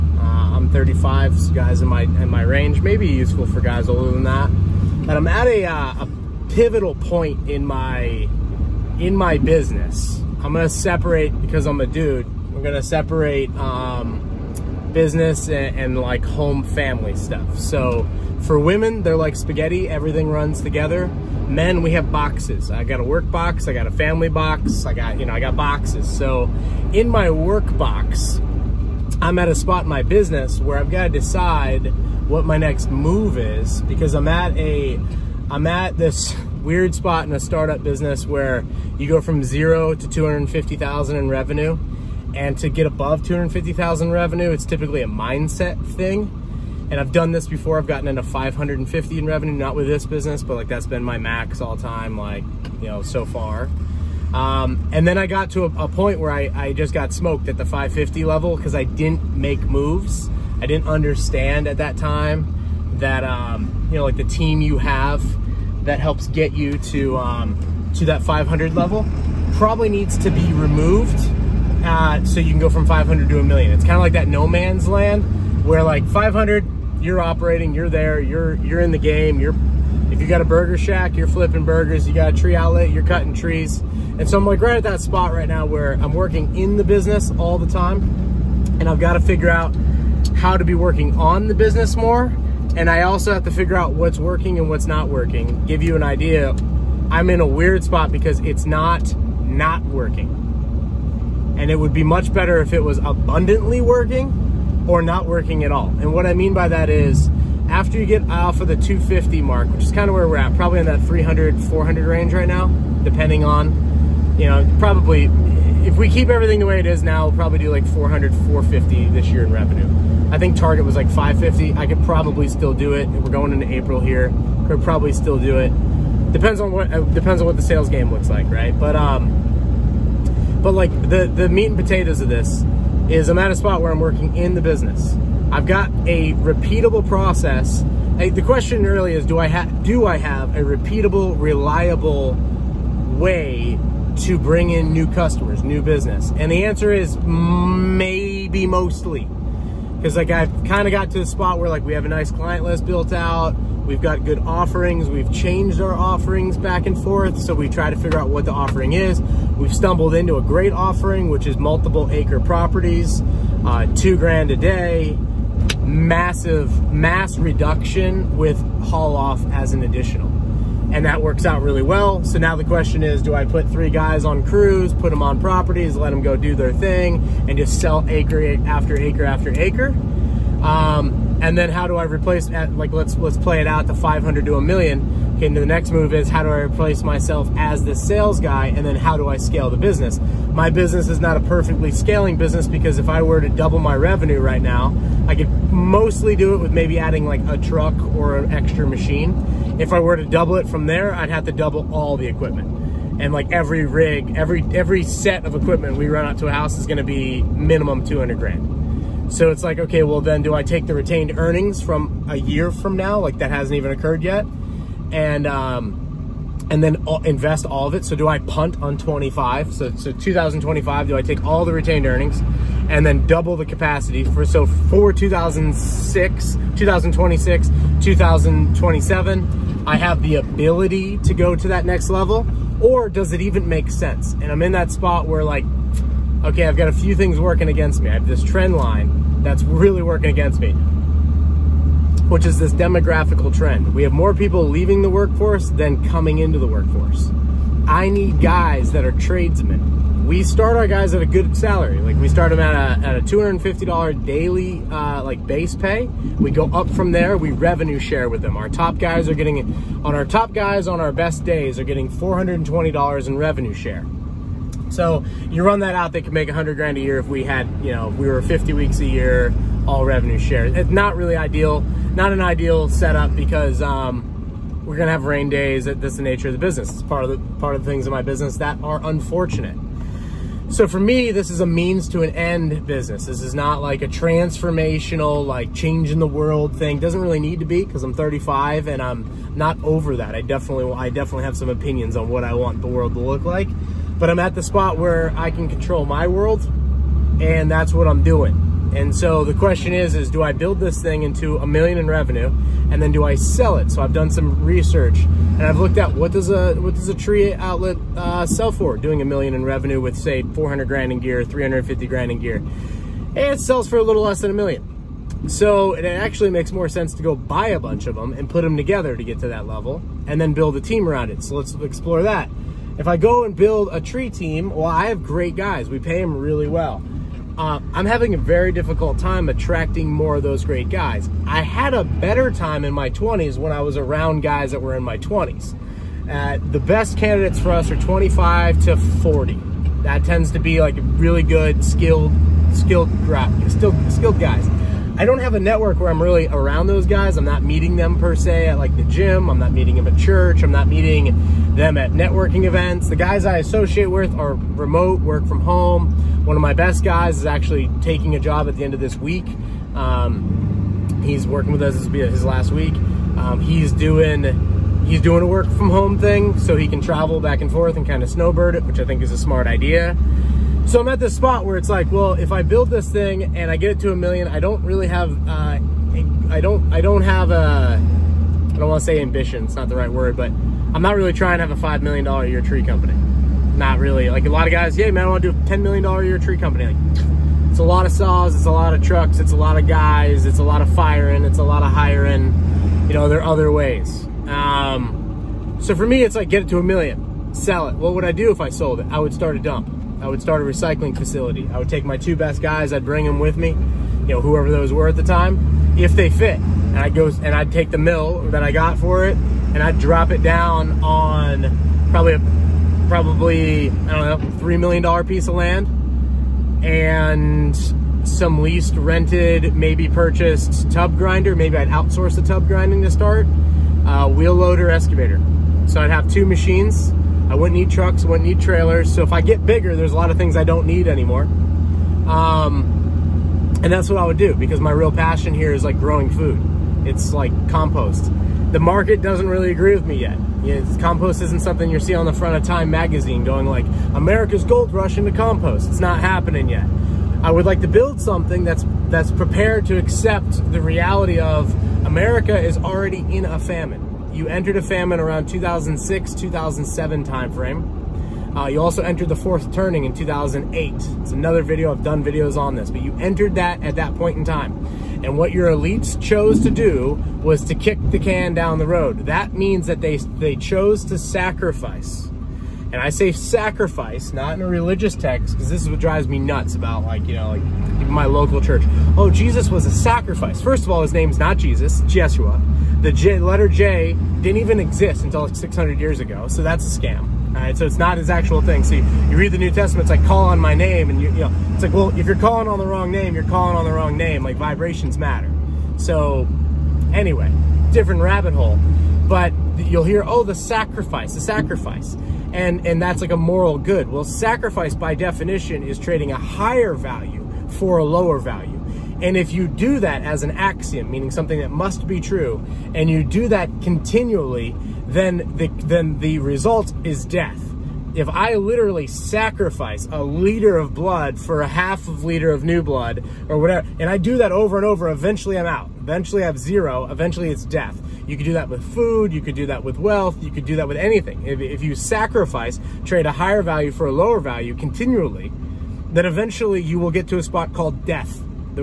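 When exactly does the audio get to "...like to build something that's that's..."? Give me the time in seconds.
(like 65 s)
447 s.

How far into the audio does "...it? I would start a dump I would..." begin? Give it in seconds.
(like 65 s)
399 s.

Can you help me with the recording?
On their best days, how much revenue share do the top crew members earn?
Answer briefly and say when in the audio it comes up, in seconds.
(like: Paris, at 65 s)
$420, at 262 s.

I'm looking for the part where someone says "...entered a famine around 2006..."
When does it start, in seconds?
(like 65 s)
454 s.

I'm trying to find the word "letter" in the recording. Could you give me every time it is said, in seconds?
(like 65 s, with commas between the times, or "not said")
483 s.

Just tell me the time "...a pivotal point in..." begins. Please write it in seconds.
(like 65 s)
6 s.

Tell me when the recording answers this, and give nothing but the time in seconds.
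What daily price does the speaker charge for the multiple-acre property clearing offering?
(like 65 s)
163 s.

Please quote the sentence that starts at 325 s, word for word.
We pay them really well uh, I'm having a very difficult time attracting more of those great guys.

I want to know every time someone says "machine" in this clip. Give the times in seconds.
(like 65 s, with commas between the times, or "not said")
198 s, 426 s.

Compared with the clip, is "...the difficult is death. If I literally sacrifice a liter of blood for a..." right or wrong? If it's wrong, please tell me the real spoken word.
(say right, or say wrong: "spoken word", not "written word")
wrong: "result", not "difficult".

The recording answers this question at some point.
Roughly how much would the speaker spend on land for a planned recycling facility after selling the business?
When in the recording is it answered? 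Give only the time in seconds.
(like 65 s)
414 s.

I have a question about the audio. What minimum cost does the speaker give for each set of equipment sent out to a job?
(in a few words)
200 grand.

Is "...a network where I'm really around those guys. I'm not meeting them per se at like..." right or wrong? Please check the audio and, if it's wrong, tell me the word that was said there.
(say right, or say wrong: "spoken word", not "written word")
right.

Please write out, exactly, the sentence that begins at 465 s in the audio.
And what your elites chose to do was to kick the can down the road.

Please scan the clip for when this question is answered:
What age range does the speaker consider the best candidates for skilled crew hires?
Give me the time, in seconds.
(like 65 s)
337 s.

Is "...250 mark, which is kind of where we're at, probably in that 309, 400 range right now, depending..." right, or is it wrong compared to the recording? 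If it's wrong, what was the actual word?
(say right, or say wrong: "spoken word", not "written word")
wrong: "300", not "309".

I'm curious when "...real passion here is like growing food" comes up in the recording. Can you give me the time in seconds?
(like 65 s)
434 s.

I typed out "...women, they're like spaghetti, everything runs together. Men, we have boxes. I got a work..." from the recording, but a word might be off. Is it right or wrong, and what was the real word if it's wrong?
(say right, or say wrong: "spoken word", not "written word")
right.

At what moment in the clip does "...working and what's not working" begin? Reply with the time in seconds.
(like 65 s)
94 s.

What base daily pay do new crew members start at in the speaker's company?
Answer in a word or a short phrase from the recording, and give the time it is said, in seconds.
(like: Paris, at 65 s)
$250, at 253 s.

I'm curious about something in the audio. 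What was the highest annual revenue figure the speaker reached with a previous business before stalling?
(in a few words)
550.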